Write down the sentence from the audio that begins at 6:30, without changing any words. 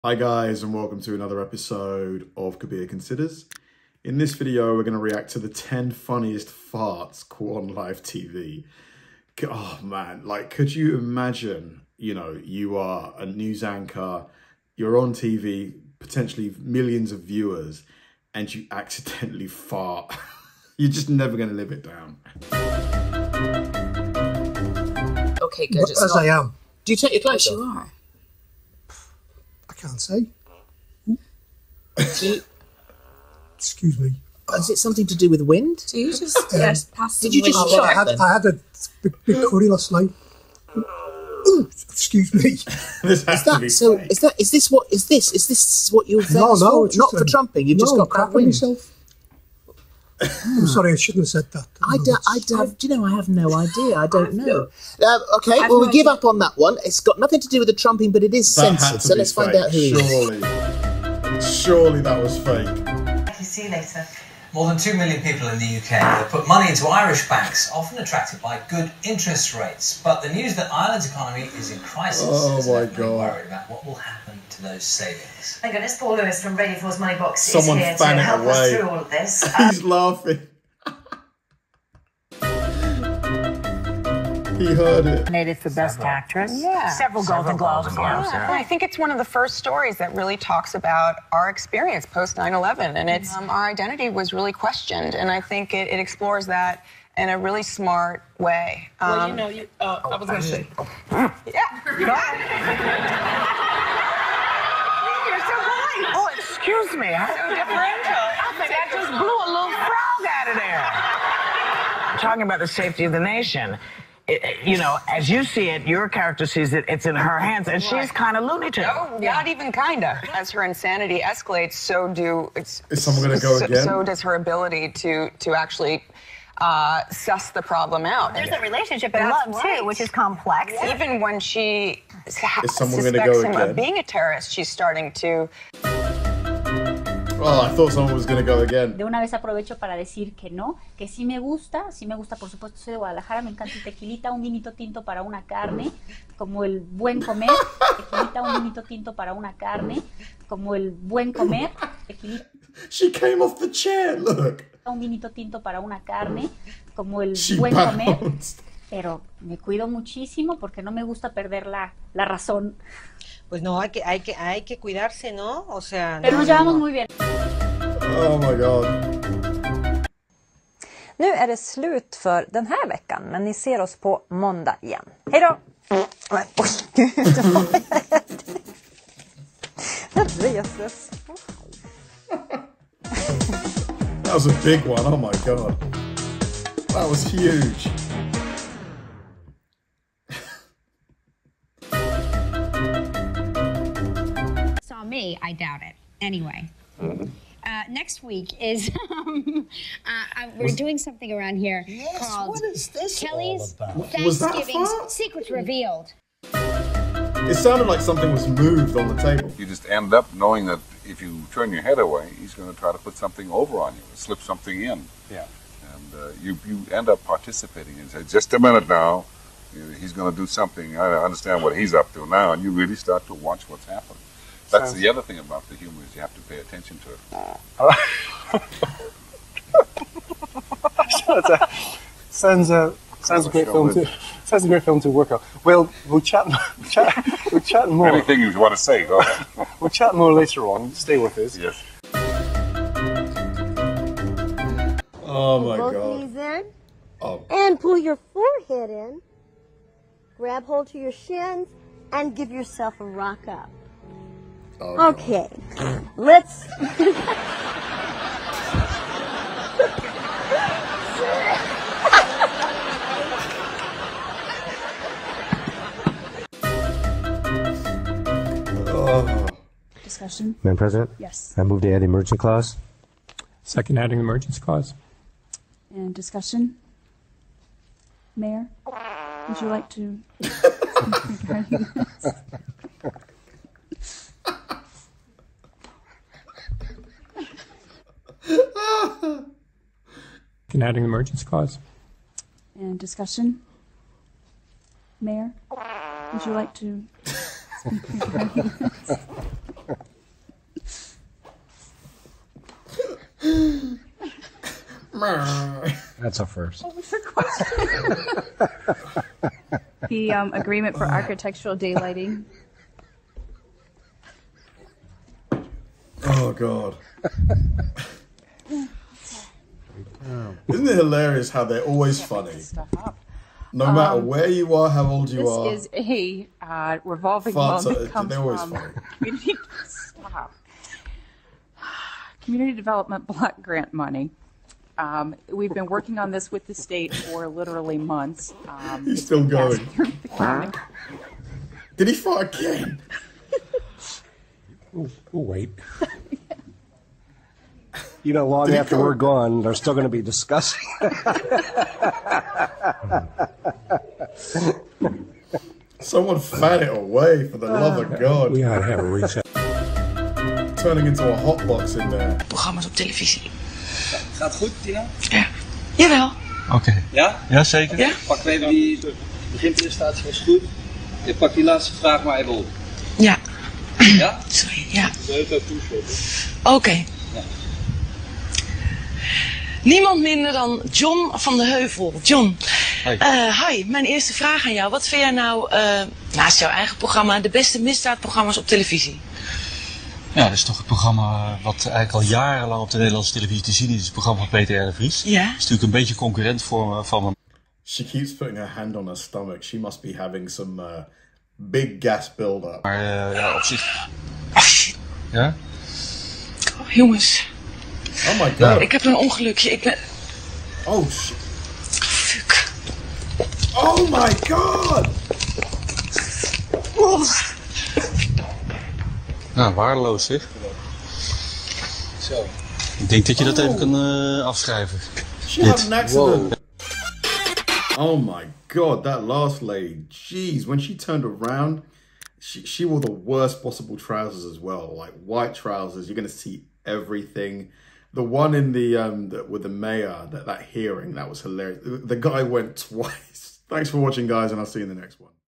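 Ja, dat is toch het programma eh, wat eigenlijk al jarenlang op de Nederlandse televisie te zien is.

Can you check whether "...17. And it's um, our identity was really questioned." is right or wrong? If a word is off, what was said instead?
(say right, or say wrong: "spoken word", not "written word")
wrong: "11", not "17".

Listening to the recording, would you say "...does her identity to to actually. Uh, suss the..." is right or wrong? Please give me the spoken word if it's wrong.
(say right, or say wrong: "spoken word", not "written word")
wrong: "ability", not "identity".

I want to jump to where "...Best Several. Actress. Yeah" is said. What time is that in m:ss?
1:25.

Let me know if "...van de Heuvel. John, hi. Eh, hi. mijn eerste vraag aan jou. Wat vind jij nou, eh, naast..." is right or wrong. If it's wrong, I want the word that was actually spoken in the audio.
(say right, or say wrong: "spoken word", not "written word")
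right.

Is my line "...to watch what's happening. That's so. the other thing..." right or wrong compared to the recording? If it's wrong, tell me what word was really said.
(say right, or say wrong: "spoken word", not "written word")
right.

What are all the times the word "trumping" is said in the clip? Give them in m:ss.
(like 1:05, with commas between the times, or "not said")
0:47, 0:57.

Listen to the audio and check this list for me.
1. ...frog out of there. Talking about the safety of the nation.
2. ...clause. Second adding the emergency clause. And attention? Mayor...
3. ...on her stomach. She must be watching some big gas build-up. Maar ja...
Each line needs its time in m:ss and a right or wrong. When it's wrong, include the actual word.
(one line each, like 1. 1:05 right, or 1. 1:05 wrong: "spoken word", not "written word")
1. 1:49 right
2. 4:32 wrong: "discussion", not "attention"
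3. 6:38 wrong: "having", not "watching".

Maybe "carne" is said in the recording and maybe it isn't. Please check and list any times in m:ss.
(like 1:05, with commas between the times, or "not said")
2:25, 2:29, 2:36.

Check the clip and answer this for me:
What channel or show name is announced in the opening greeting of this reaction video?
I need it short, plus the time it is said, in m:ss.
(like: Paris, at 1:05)
Kabir Considers, at 0:02.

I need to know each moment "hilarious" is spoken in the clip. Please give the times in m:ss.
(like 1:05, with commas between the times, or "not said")
5:20, 7:21.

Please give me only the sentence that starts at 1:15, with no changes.
Thank goodness Paul Lewis from Radio 4's Money Box Someone is here to help away.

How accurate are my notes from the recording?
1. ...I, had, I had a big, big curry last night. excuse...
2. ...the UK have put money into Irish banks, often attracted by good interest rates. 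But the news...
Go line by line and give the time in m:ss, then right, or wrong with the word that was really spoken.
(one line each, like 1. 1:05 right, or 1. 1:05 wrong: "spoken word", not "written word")
1. 0:37 right
2. 1:05 right.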